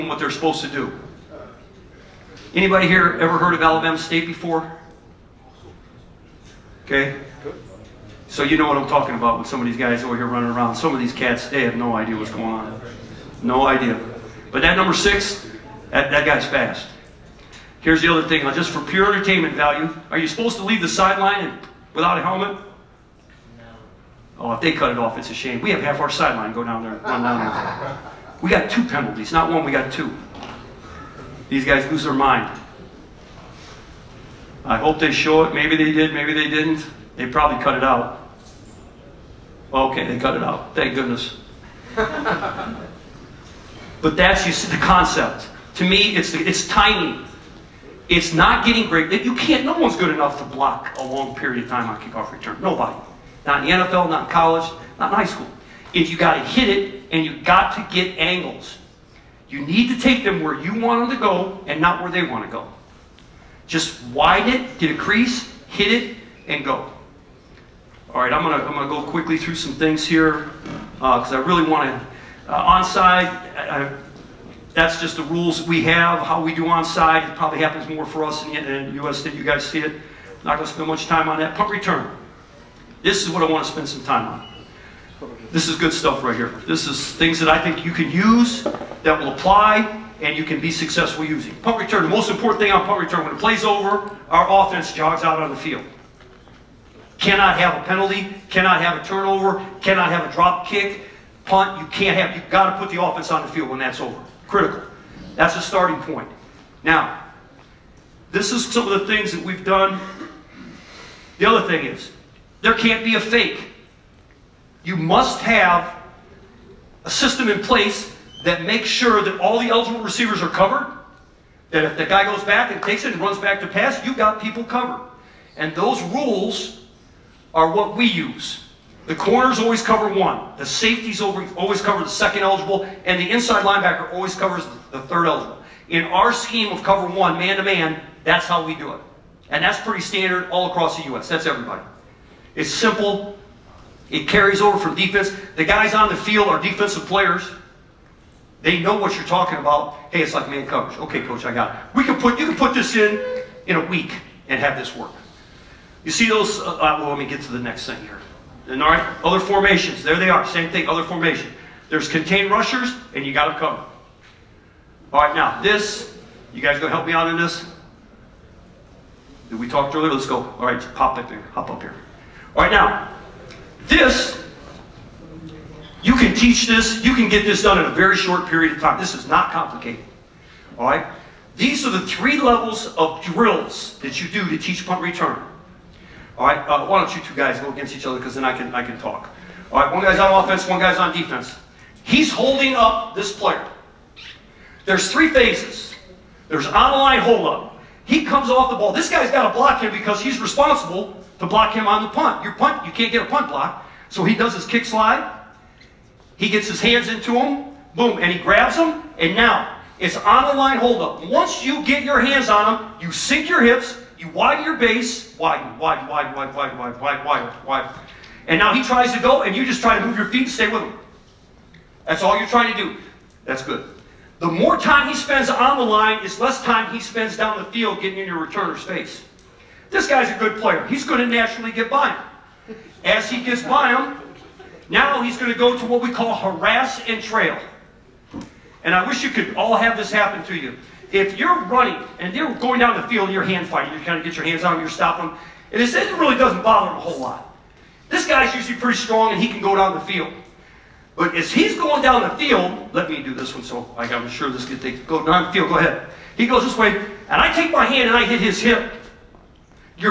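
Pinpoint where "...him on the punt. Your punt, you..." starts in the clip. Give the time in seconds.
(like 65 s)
201 s.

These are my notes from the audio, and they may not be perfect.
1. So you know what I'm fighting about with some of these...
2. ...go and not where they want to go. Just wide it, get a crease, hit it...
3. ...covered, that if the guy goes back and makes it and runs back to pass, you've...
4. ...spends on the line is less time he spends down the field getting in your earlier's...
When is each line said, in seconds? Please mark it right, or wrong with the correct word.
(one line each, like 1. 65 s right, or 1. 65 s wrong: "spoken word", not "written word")
1. 8 s wrong: "talking", not "fighting"
2. 61 s right
3. 120 s wrong: "takes", not "makes"
4. 225 s wrong: "returner", not "earlier".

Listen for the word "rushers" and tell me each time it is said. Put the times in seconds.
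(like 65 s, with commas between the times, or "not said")
162 s.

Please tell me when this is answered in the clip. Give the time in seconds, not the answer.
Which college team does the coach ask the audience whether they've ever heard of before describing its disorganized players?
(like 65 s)
3 s.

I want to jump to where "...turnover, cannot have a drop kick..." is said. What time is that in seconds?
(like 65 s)
99 s.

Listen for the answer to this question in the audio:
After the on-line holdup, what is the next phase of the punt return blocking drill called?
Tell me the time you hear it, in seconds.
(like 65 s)
236 s.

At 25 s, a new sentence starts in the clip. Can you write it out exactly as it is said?
We have half our sideline go down there and run down there.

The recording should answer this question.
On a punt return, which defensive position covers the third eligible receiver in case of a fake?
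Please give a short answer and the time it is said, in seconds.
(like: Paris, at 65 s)
inside linebacker, at 133 s.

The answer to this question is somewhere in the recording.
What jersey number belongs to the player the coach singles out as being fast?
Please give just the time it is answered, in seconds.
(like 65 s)
14 s.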